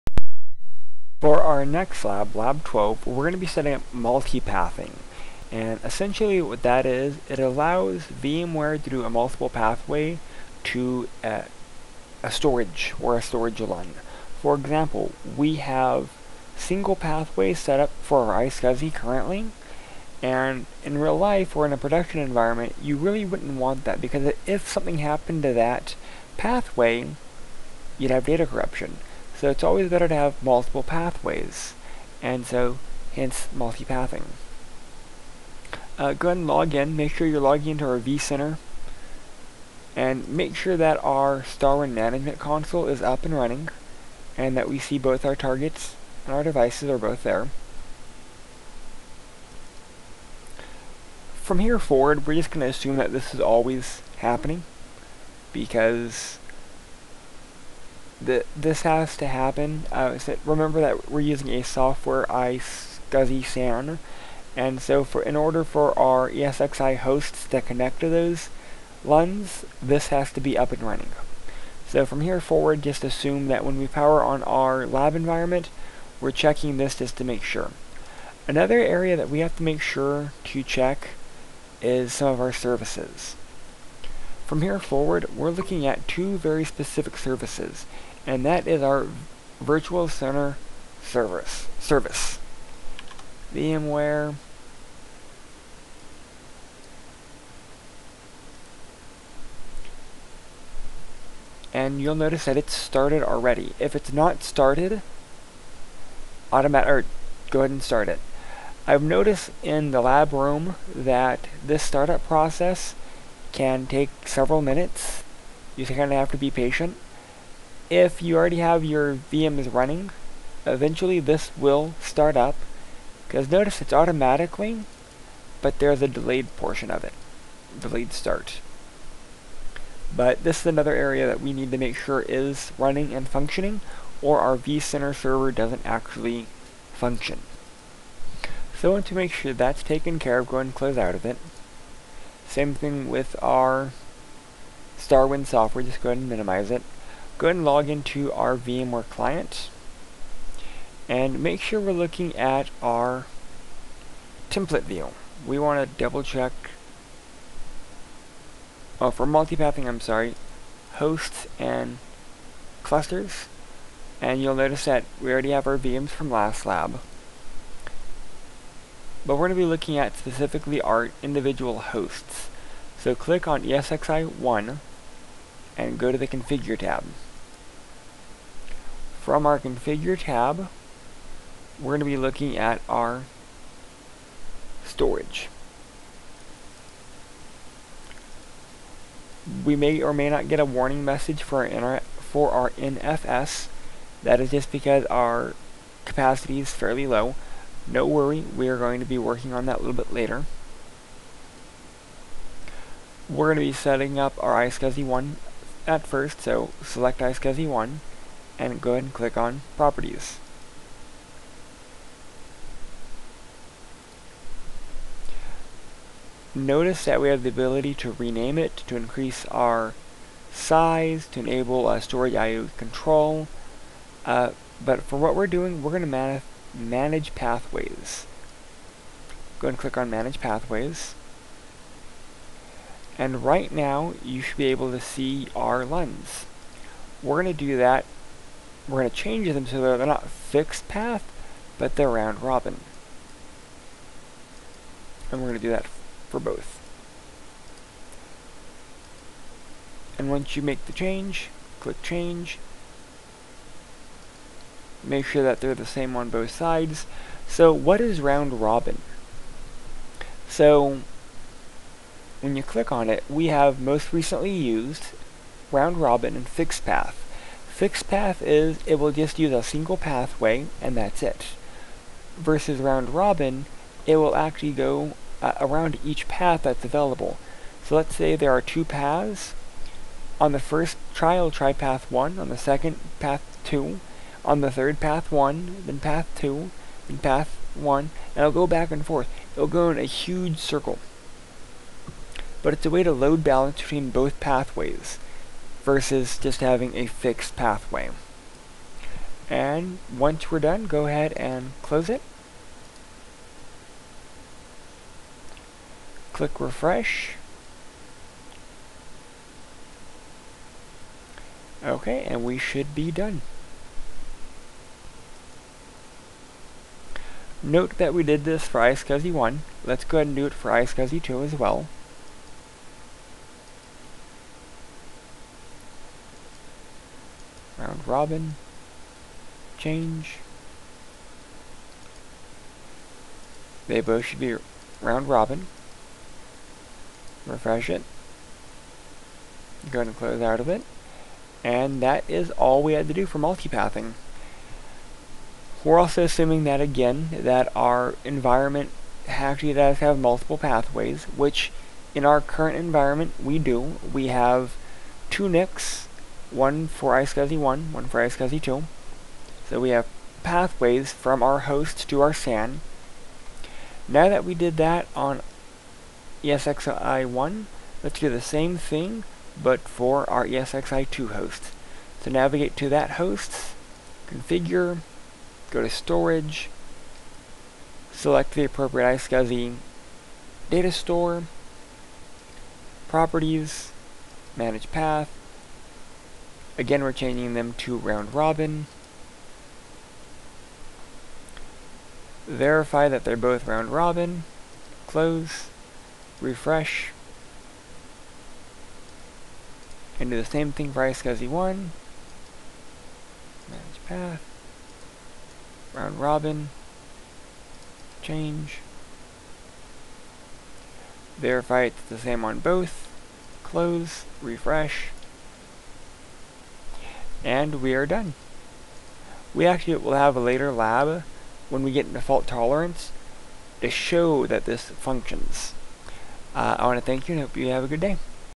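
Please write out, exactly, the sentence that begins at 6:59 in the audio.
We actually will have a later lab when we get into fault tolerance to show that this functions.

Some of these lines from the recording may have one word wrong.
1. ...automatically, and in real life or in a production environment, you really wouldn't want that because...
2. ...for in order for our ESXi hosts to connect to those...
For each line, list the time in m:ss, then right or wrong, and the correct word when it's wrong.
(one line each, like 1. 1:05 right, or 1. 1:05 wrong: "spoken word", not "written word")
1. 0:18 wrong: "currently", not "automatically"
2. 1:05 right.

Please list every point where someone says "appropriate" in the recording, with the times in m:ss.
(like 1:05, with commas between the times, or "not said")
6:18.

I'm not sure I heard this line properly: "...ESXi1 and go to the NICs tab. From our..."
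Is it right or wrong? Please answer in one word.
wrong.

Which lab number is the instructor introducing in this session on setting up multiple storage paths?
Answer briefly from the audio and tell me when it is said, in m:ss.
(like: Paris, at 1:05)
Lab 12, at 0:02.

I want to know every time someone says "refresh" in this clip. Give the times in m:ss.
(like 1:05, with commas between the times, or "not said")
5:06, 5:37, 6:36, 6:54.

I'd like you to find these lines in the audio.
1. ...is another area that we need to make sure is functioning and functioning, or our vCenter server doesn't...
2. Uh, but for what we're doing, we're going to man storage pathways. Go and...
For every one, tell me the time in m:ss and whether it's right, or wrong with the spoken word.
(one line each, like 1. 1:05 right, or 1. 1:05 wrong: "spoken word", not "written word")
1. 2:10 wrong: "running", not "functioning"
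2. 3:44 wrong: "manage", not "storage".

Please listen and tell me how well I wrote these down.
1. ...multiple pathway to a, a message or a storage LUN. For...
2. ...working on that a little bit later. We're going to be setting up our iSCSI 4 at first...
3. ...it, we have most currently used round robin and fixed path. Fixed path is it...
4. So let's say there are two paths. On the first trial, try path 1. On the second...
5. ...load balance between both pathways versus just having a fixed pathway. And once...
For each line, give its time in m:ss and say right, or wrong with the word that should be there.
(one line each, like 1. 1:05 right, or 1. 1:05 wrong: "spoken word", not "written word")
1. 0:09 wrong: "storage", not "message"
2. 3:19 wrong: "1", not "4"
3. 4:23 wrong: "recently", not "currently"
4. 4:37 right
5. 4:53 right.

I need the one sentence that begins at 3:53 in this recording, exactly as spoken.
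And right now, you should be able to see our LUNs.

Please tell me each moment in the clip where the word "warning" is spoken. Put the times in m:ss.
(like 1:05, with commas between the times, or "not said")
3:10.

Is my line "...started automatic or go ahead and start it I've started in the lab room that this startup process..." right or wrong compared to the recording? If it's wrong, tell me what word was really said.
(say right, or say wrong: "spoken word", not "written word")
wrong: "noticed", not "started".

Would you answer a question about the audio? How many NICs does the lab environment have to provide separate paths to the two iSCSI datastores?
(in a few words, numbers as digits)
2.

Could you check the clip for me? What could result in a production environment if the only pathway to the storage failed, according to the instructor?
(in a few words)
Data corruption.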